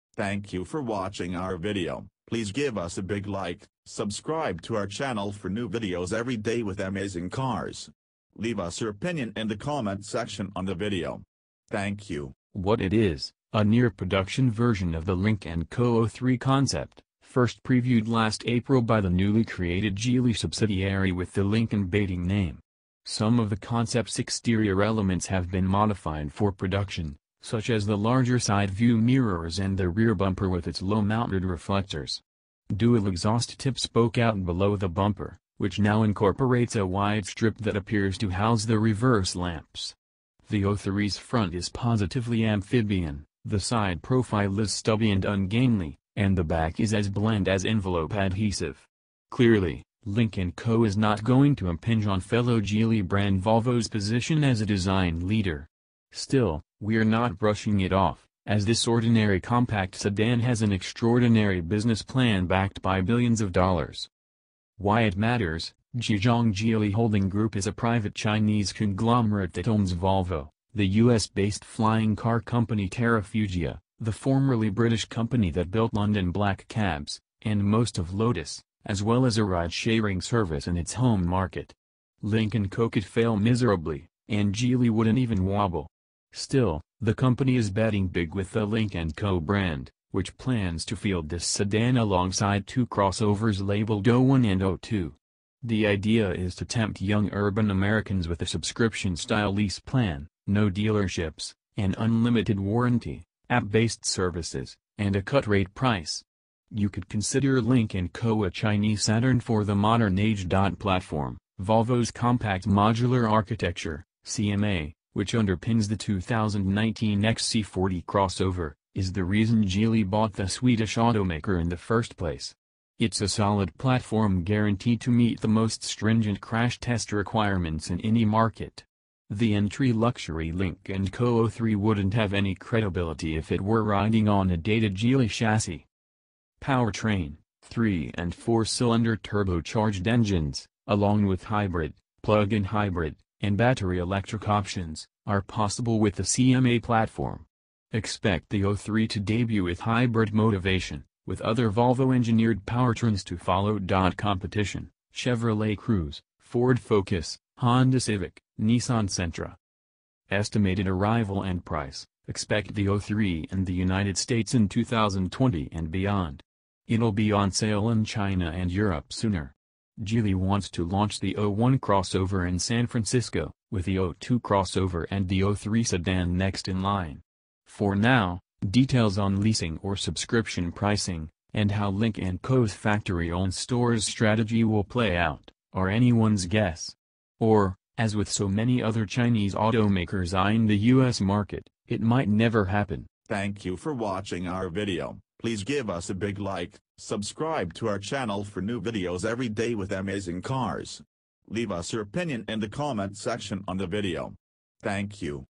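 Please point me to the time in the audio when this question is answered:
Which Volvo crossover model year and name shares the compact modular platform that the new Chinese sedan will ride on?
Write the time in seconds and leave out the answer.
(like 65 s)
115 s.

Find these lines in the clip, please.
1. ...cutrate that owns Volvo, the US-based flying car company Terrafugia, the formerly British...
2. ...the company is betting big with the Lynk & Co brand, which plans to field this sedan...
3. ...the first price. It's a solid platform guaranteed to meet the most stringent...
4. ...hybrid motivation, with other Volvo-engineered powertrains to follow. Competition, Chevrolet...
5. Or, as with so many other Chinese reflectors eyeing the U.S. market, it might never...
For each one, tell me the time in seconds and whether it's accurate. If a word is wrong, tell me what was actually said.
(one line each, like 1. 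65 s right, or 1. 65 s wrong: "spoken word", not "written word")
1. 68 s wrong: "conglomerate", not "cutrate"
2. 87 s right
3. 121 s wrong: "place", not "price"
4. 149 s right
5. 187 s wrong: "automakers", not "reflectors".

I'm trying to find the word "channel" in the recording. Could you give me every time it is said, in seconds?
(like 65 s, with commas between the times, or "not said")
4 s, 197 s.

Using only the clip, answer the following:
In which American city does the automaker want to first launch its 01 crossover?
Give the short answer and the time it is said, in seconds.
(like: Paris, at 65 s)
San Francisco, at 172 s.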